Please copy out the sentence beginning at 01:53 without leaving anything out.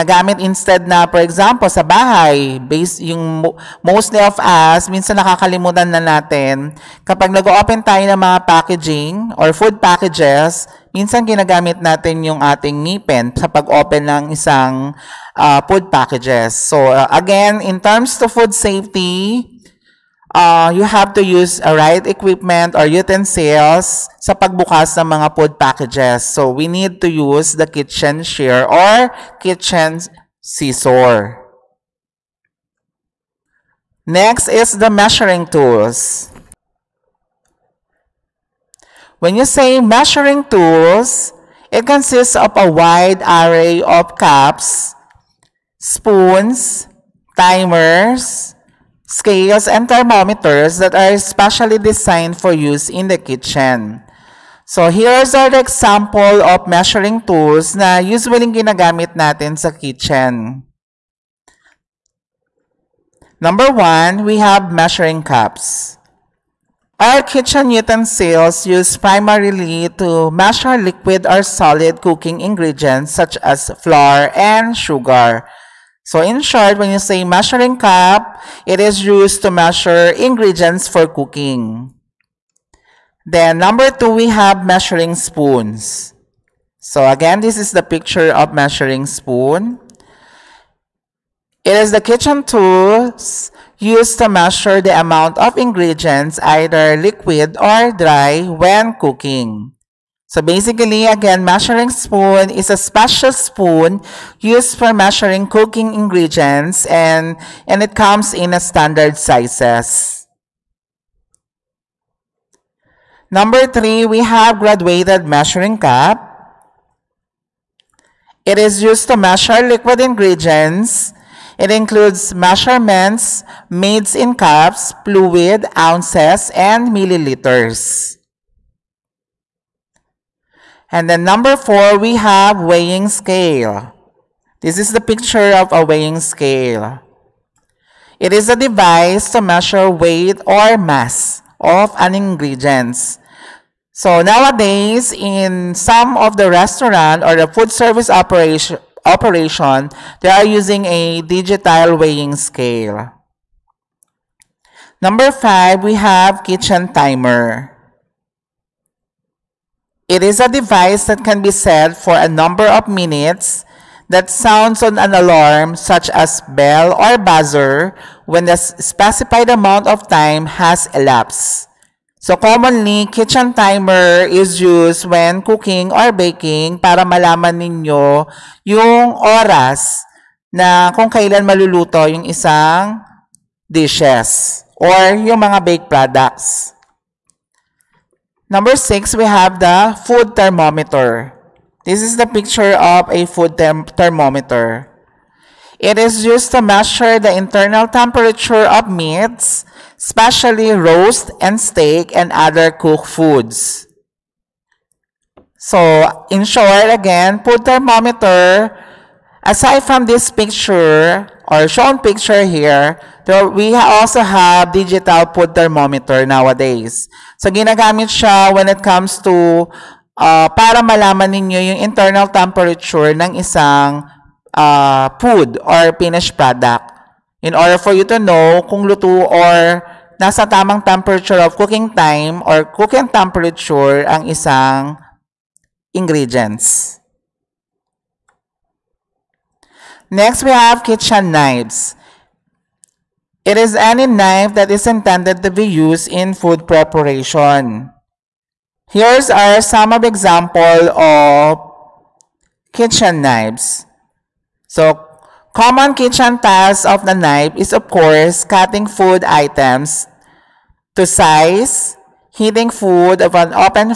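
Number three, we have graduated measuring cup.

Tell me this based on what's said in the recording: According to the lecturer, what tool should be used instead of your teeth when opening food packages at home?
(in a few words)
kitchen shear.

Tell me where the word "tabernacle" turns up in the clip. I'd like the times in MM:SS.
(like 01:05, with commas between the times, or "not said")
not said.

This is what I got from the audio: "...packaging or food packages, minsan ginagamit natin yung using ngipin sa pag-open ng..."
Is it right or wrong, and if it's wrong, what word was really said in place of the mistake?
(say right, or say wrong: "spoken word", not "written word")
wrong: "ating", not "using".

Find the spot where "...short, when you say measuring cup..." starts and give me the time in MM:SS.
01:16.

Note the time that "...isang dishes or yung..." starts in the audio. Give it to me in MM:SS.
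03:02.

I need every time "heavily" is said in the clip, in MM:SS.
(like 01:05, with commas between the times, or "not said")
not said.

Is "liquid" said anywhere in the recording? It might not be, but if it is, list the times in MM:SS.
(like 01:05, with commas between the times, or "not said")
01:10, 01:36, 01:59.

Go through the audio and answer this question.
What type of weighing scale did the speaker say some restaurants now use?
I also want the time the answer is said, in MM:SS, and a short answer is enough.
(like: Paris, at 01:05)
digital weighing scale, at 02:31.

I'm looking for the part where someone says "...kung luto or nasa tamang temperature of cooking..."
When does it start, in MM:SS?
03:48.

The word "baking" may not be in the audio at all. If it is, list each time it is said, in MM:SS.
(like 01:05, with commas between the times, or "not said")
02:56.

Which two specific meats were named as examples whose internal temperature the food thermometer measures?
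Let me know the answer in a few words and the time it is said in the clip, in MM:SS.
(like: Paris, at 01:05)
roast and steak, at 03:20.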